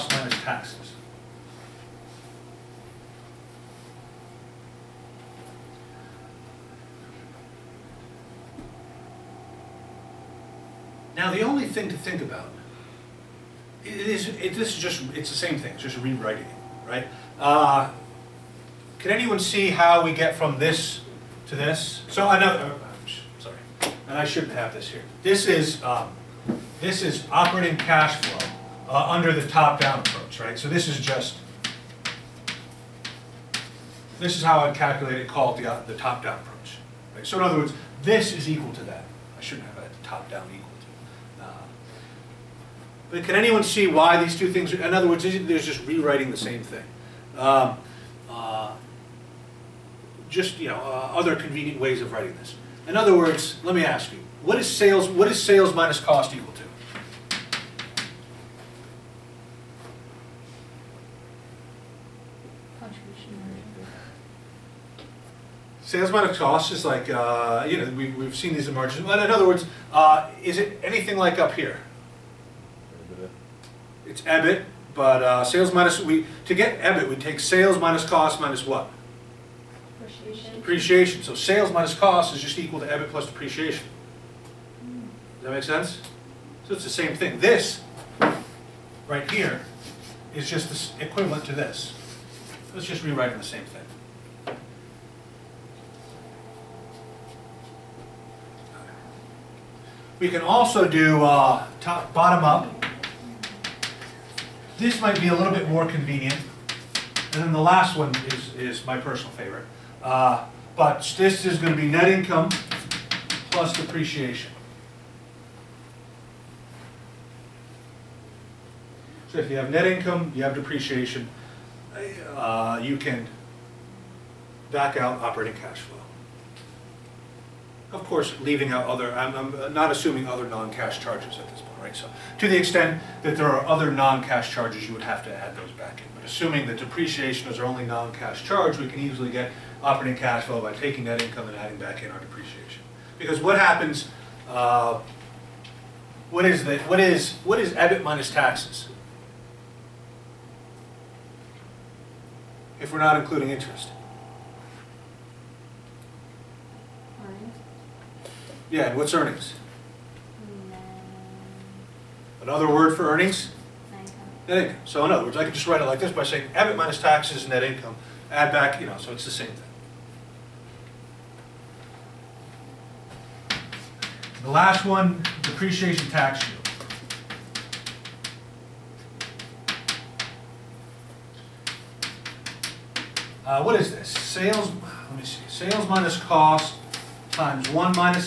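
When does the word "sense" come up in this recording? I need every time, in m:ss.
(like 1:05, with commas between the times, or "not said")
1:25.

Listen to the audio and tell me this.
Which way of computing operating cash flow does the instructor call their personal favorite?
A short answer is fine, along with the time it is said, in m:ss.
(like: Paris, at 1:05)
net income plus depreciation, at 1:51.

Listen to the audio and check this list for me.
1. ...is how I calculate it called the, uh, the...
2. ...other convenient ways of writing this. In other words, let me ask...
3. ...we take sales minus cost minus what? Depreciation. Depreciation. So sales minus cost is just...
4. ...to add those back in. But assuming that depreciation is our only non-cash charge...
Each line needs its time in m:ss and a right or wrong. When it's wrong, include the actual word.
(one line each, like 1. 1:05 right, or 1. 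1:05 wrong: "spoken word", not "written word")
1. 0:34 right
2. 0:51 right
3. 1:17 right
4. 2:15 right.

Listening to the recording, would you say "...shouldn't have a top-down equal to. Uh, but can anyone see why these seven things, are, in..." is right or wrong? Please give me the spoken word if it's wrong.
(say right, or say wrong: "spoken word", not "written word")
wrong: "two", not "seven".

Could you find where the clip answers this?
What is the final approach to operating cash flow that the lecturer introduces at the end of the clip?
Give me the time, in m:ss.
2:55.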